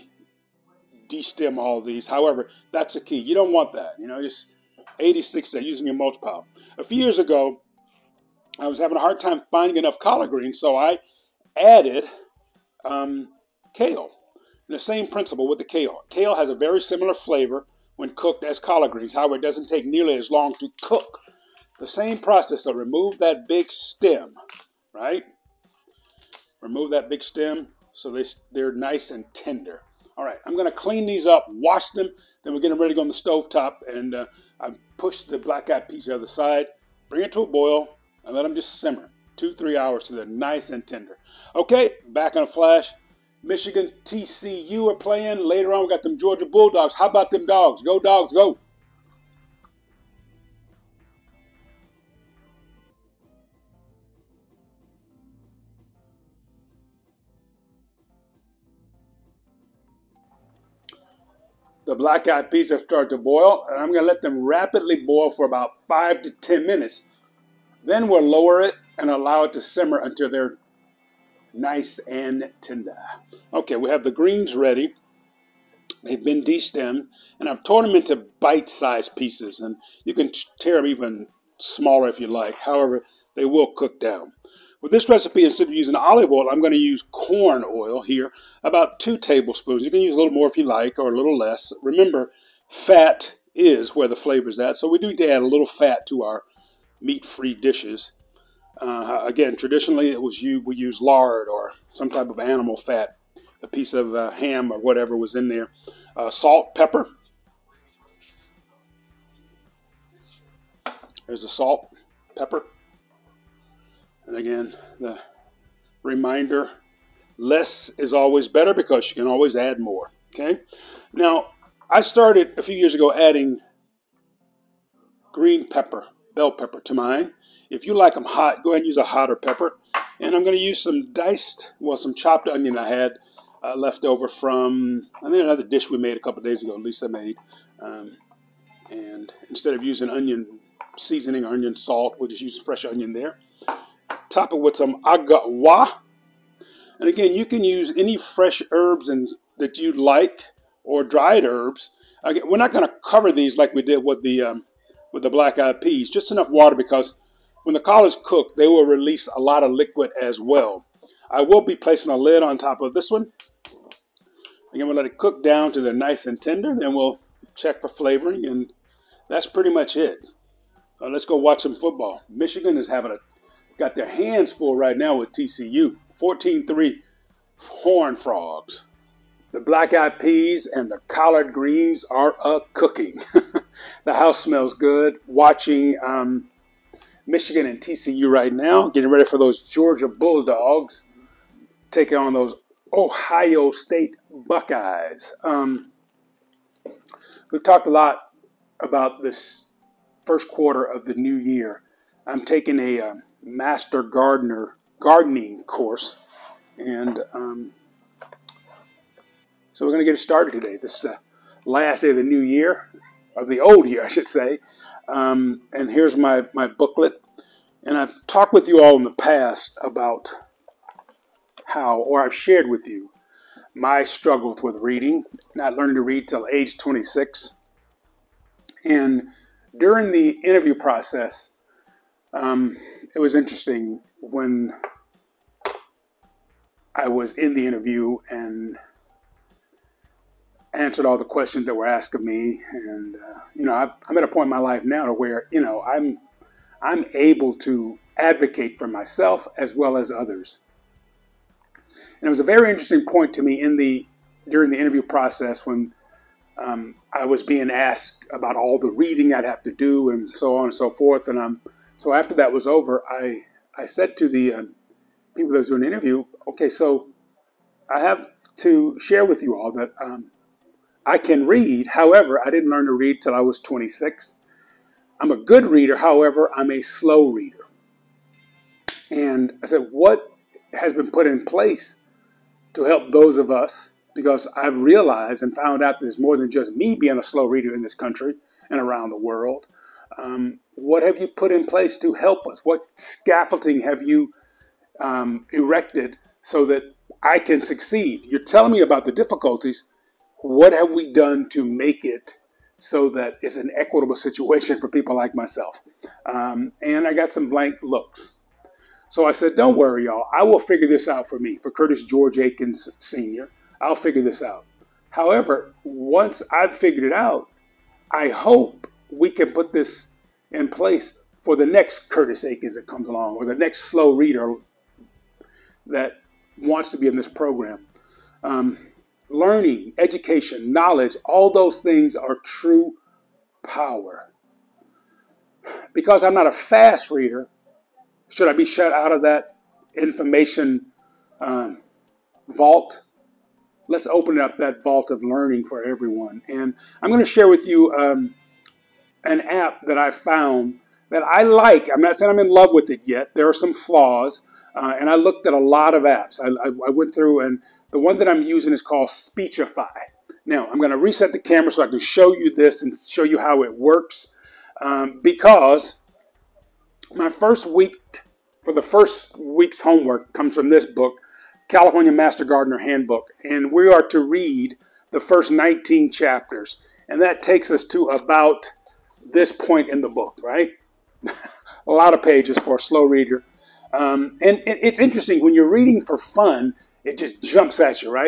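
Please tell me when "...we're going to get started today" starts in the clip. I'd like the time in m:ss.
3:29.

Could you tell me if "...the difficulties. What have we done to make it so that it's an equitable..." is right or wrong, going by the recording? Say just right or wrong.
right.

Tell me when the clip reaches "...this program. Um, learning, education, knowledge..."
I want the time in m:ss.
5:27.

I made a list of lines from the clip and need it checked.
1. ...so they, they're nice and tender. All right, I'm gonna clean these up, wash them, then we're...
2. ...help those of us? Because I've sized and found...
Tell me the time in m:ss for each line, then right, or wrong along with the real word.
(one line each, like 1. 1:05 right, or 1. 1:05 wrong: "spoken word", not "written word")
1. 0:27 right
2. 4:42 wrong: "realized", not "sized".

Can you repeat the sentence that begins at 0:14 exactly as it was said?
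And the same principle with the kale.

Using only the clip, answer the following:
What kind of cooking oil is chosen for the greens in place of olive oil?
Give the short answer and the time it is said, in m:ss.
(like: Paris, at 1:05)
corn oil, at 1:27.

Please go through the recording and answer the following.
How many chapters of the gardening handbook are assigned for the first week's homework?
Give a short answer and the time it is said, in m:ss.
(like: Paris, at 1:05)
19, at 6:15.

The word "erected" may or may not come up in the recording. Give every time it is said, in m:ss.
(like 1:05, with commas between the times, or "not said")
4:55.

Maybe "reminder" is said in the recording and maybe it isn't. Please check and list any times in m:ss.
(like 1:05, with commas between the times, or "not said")
1:56.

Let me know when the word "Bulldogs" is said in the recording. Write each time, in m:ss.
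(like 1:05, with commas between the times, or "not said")
0:46, 3:10.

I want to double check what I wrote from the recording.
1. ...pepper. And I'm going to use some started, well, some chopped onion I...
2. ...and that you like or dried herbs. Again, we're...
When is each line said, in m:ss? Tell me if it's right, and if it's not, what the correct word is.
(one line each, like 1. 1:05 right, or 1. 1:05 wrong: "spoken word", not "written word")
1. 2:09 wrong: "diced", not "started"
2. 2:29 right.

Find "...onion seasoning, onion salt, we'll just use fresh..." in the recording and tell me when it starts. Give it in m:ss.
2:20.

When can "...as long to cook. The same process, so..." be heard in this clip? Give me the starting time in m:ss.
0:20.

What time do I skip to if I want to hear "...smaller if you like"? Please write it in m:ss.
1:21.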